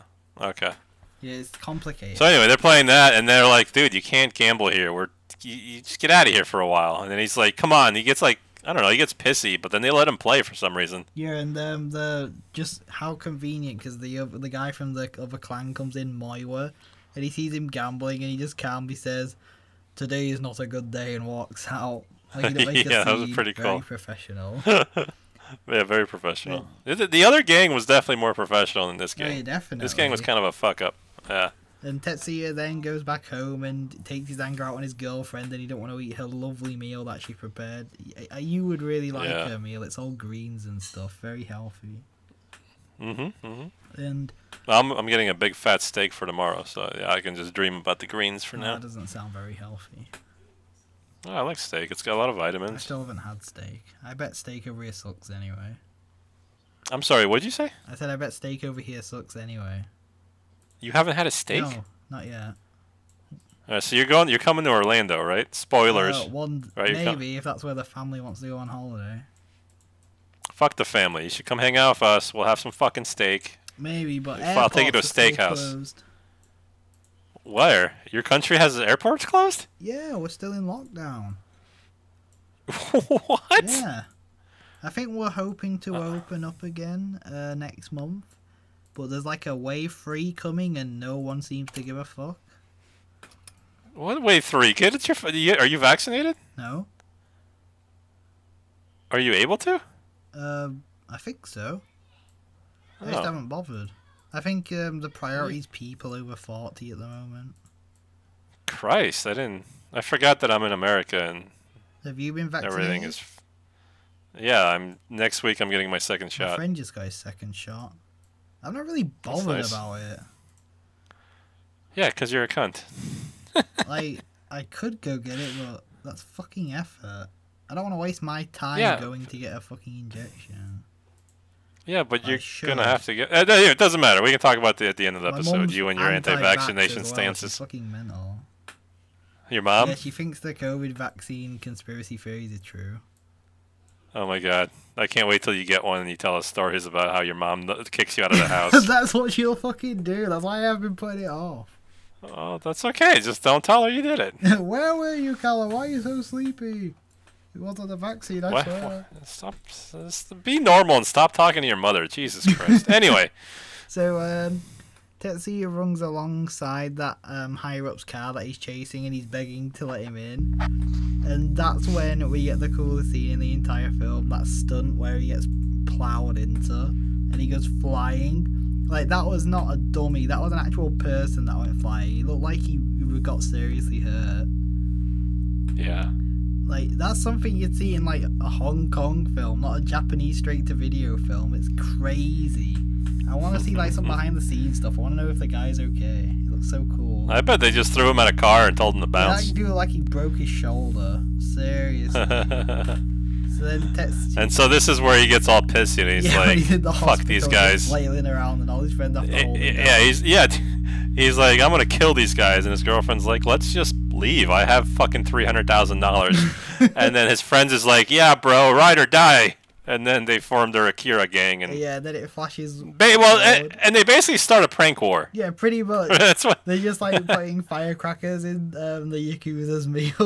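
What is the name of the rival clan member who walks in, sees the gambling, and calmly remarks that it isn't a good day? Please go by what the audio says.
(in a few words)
Moiwa.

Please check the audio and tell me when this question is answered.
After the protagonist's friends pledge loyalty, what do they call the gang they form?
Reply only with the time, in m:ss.
3:40.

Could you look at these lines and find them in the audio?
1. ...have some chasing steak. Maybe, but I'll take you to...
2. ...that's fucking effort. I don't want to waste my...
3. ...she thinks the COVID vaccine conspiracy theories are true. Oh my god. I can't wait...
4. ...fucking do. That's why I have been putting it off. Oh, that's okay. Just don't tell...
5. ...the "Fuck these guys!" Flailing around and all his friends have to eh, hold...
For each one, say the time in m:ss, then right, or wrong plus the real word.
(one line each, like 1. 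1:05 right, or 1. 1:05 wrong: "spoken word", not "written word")
1. 1:12 wrong: "fucking", not "chasing"
2. 2:06 right
3. 2:19 right
4. 2:29 right
5. 3:26 right.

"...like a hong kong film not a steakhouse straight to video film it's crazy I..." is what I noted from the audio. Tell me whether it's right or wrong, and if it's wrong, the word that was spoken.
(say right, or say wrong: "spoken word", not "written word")
wrong: "japanese", not "steakhouse".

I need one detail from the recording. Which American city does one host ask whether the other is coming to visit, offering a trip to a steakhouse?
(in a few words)
Orlando.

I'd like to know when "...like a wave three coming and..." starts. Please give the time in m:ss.
1:29.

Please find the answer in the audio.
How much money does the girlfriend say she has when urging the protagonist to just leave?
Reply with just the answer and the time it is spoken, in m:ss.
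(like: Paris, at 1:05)
300,000 dollars, at 3:35.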